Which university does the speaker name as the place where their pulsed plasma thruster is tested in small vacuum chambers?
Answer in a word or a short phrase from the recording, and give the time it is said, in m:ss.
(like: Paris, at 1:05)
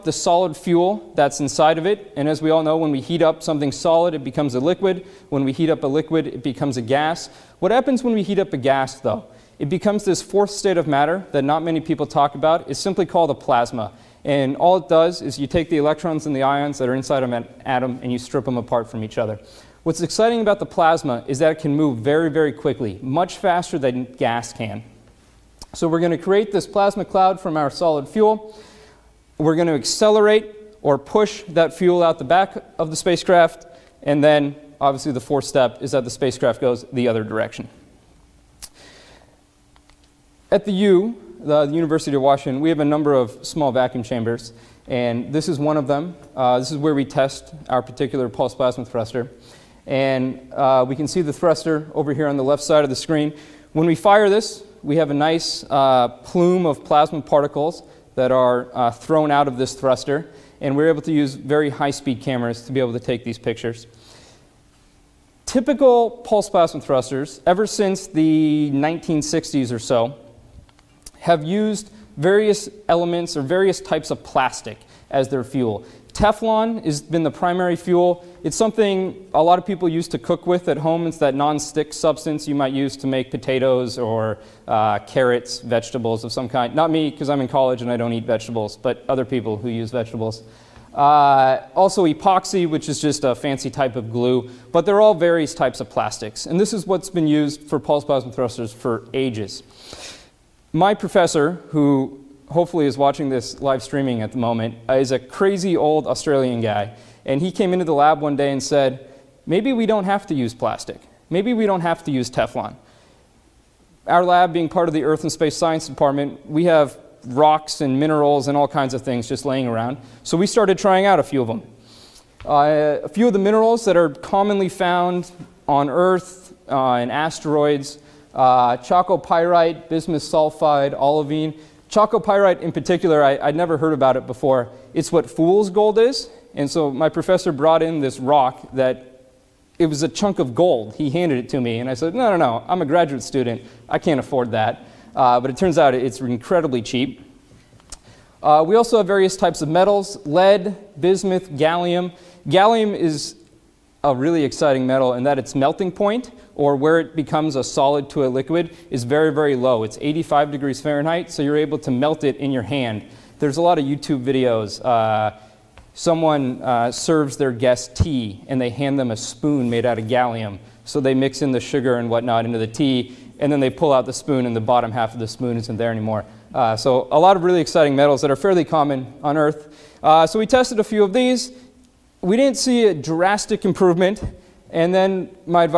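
University of Washington, at 0:41.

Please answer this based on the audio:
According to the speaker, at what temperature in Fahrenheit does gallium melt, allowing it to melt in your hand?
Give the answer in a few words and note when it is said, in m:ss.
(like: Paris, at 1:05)
85 degrees Fahrenheit, at 2:39.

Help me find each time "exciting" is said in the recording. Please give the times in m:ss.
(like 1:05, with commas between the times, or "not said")
0:19, 2:34, 2:57.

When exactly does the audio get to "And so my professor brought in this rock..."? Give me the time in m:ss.
2:16.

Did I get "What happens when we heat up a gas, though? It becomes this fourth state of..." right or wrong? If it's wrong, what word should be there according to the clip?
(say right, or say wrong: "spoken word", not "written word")
right.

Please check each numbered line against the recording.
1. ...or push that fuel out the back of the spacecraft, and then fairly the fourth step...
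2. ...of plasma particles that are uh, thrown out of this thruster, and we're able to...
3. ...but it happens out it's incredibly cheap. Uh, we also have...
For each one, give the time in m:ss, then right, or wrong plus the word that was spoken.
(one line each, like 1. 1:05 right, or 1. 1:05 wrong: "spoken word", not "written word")
1. 0:30 wrong: "obviously", not "fairly"
2. 0:56 right
3. 2:25 wrong: "turns", not "happens".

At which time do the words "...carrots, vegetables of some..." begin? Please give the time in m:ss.
1:24.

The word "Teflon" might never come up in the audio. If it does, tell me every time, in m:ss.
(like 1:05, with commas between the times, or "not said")
1:16, 1:52.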